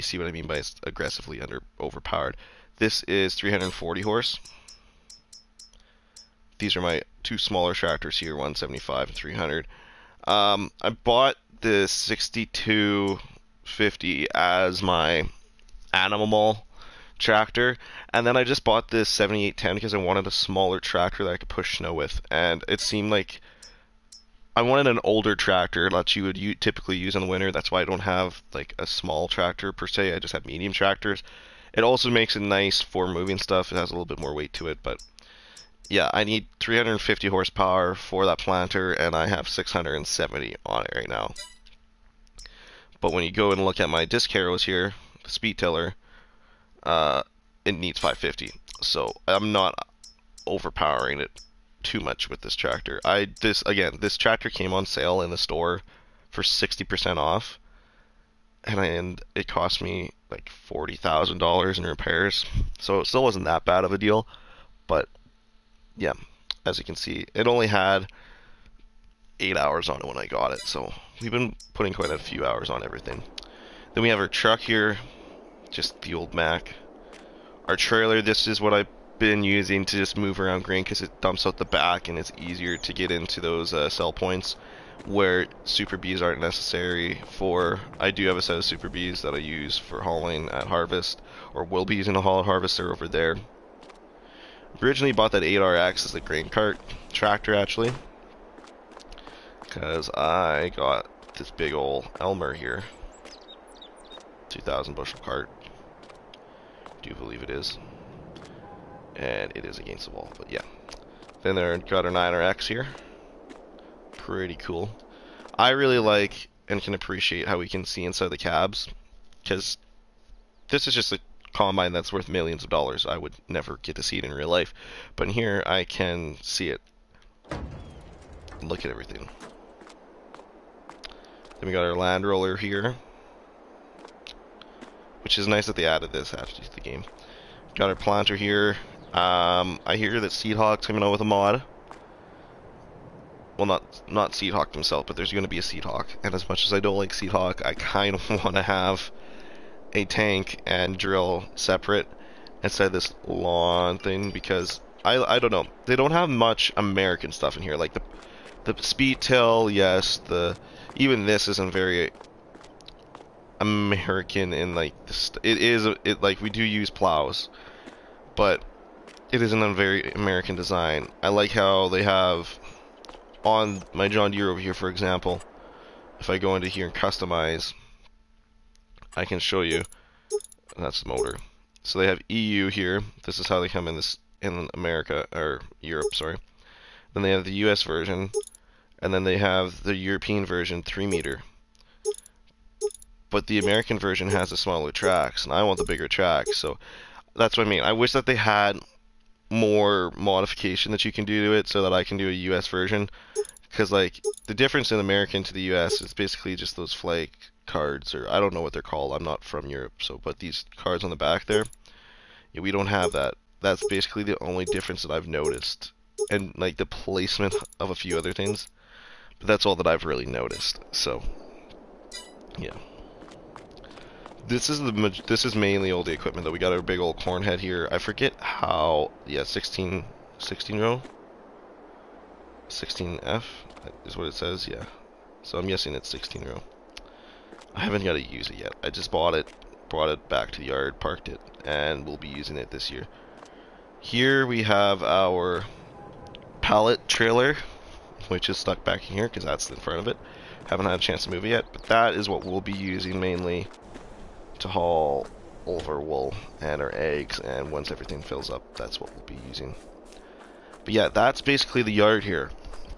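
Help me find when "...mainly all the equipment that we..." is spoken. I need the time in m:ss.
3:45.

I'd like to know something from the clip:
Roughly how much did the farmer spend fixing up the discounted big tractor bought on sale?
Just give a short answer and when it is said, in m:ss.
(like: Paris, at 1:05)
$40,000, at 1:00.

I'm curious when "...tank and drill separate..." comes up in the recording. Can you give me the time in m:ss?
2:30.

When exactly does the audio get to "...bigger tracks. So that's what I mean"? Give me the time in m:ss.
3:15.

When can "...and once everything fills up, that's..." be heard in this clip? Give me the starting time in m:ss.
4:17.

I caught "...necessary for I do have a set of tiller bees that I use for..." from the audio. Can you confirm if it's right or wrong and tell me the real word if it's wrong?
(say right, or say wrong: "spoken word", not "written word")
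wrong: "super", not "tiller".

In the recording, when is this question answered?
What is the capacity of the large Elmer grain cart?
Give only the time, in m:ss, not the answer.
1:44.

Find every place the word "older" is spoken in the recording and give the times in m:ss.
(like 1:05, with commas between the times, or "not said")
0:25.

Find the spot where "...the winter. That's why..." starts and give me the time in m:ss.
0:27.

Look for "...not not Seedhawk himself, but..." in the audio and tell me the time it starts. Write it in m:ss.
2:23.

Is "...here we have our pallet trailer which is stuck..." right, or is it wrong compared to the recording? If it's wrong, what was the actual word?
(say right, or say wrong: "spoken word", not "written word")
right.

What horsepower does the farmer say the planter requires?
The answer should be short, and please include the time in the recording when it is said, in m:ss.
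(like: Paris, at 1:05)
350, at 0:36.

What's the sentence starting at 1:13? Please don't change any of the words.
Then we have our truck here, just the old Mack.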